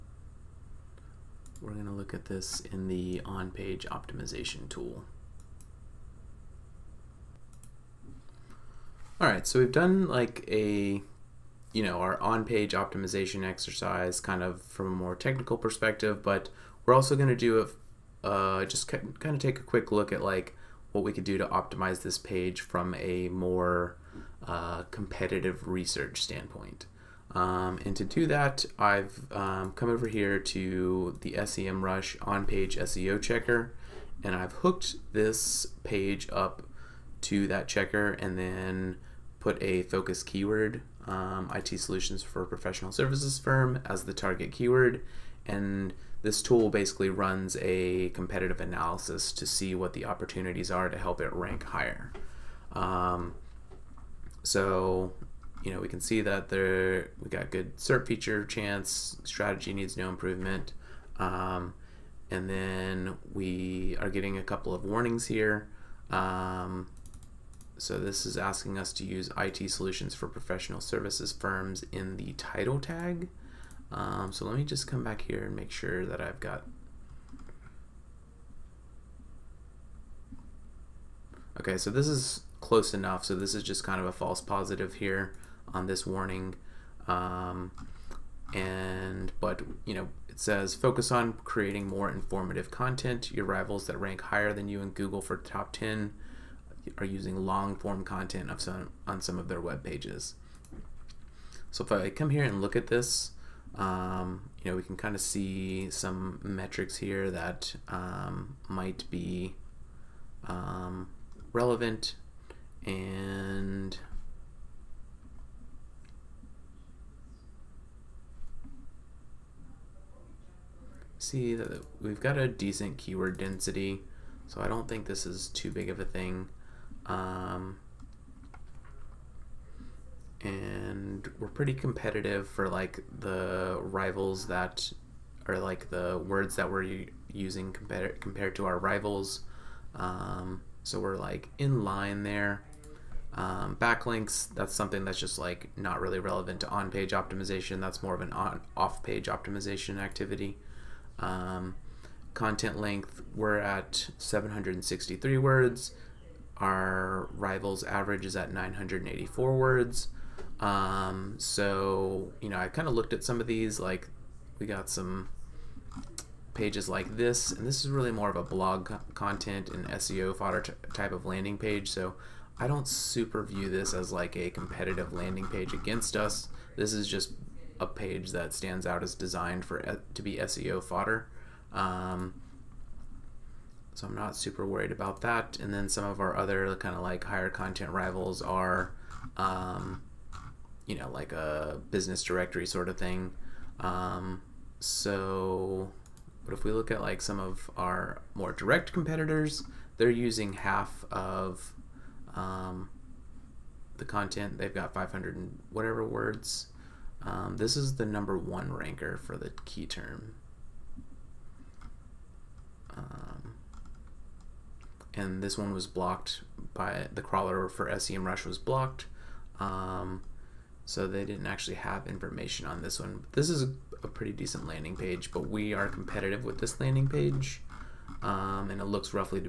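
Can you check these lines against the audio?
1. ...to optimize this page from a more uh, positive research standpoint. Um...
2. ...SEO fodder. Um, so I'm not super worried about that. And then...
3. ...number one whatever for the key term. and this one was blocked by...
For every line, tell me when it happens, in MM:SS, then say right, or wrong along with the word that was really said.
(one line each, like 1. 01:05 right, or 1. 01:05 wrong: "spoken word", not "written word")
1. 00:21 wrong: "competitive", not "positive"
2. 03:00 right
3. 03:28 wrong: "ranker", not "whatever".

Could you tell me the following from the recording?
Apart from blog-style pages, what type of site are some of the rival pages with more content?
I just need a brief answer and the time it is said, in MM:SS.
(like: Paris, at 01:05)
business directory, at 03:11.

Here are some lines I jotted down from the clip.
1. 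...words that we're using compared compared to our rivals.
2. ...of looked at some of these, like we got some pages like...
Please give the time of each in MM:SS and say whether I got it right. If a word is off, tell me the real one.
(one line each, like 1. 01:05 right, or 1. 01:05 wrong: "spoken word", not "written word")
1. 02:16 right
2. 02:42 right.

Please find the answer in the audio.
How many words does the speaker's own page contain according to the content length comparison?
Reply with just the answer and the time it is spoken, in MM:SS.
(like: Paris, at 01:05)
763, at 02:34.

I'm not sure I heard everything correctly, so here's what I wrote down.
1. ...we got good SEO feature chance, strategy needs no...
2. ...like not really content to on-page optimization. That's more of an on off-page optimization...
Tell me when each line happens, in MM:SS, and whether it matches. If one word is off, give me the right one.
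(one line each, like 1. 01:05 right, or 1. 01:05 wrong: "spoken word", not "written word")
1. 00:57 wrong: "SERP", not "SEO"
2. 02:25 wrong: "relevant", not "content".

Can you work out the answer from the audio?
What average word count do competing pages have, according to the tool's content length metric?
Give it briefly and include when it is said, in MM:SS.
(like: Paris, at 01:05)
984, at 02:38.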